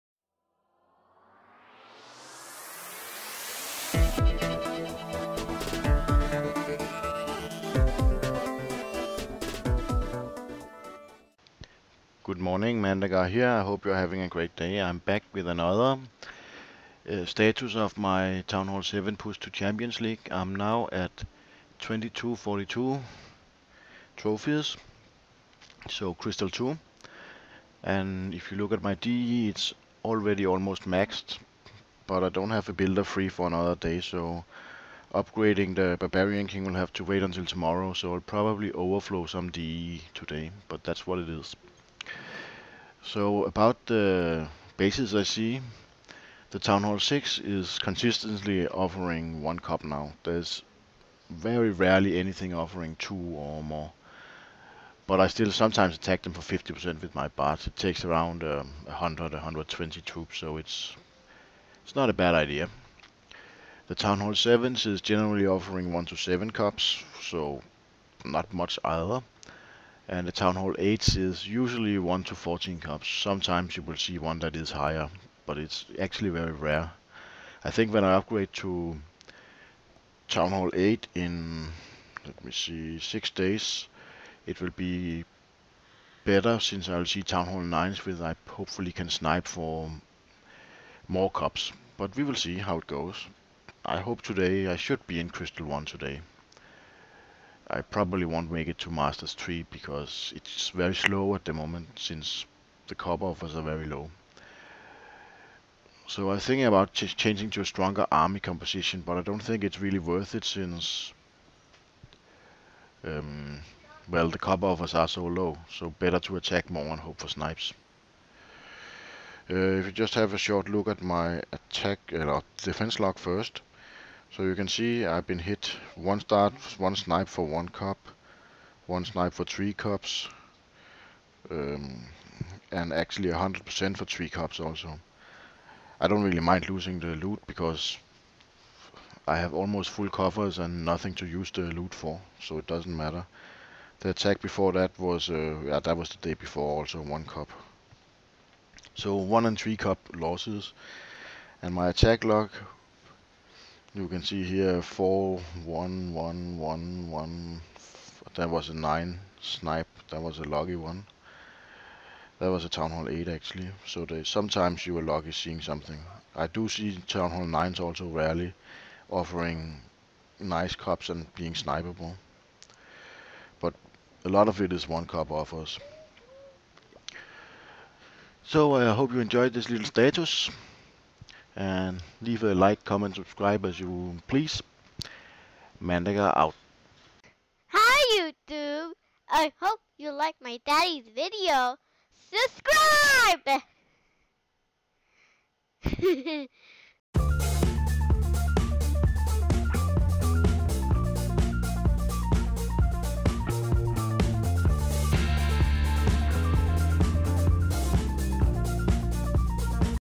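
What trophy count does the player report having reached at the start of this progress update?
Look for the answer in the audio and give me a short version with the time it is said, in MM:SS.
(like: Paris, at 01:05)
2242, at 00:21.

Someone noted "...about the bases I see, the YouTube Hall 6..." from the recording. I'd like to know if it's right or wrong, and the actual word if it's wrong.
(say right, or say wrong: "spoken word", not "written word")
wrong: "Town", not "YouTube".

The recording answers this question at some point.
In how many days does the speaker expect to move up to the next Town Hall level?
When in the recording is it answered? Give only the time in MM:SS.
01:22.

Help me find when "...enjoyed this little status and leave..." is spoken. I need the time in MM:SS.
02:59.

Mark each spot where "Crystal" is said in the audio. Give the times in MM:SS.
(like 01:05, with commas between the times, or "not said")
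00:26, 01:35.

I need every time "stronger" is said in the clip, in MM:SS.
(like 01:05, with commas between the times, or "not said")
01:47.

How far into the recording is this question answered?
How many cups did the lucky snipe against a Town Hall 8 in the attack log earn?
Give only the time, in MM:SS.
02:38.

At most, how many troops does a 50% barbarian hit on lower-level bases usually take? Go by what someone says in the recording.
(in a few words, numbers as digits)
120.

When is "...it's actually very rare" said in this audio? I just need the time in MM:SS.
01:15.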